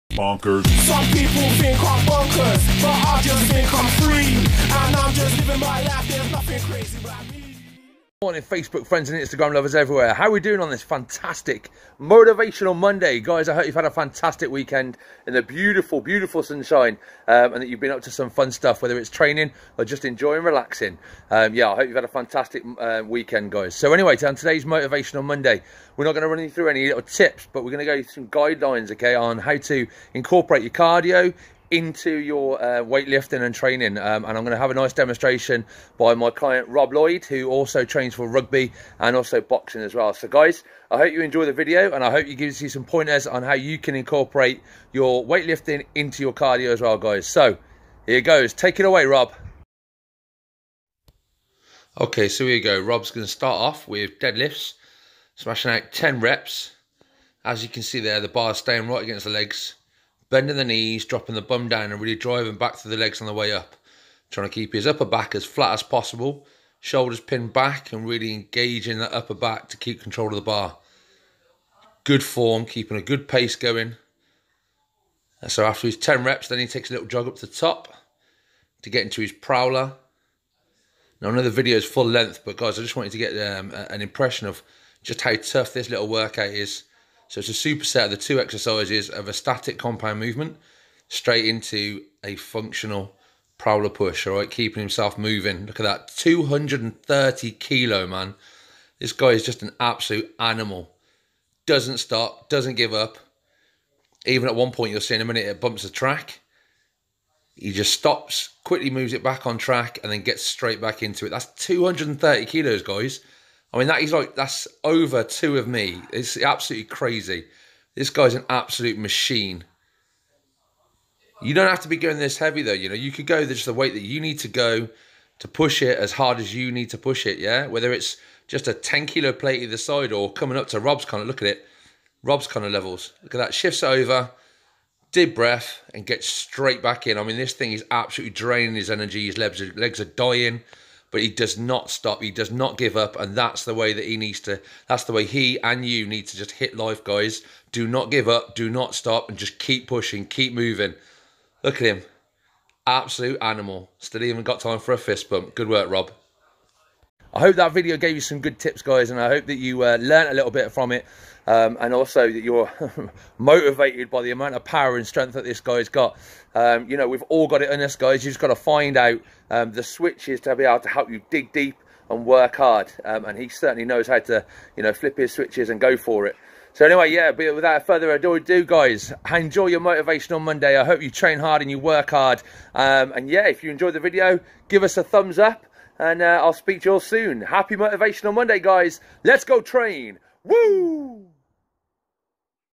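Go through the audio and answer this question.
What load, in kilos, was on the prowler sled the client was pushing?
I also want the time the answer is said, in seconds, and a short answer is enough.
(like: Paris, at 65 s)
230 kilos, at 96 s.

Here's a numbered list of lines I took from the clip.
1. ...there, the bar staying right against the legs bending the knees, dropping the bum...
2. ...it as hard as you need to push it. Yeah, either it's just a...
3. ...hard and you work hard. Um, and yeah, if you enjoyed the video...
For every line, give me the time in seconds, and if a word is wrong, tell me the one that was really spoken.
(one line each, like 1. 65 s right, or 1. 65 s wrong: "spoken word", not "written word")
1. 57 s right
2. 125 s wrong: "whether", not "either"
3. 181 s right.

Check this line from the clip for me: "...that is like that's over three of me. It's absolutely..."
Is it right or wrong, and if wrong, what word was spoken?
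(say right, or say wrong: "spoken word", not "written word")
wrong: "two", not "three".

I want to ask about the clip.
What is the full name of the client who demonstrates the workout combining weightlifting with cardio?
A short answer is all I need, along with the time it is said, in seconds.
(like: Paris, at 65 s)
Rob Lloyd, at 36 s.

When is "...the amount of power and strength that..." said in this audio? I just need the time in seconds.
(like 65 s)
164 s.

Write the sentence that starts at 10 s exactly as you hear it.
How are we doing on this fantastic motivational Monday?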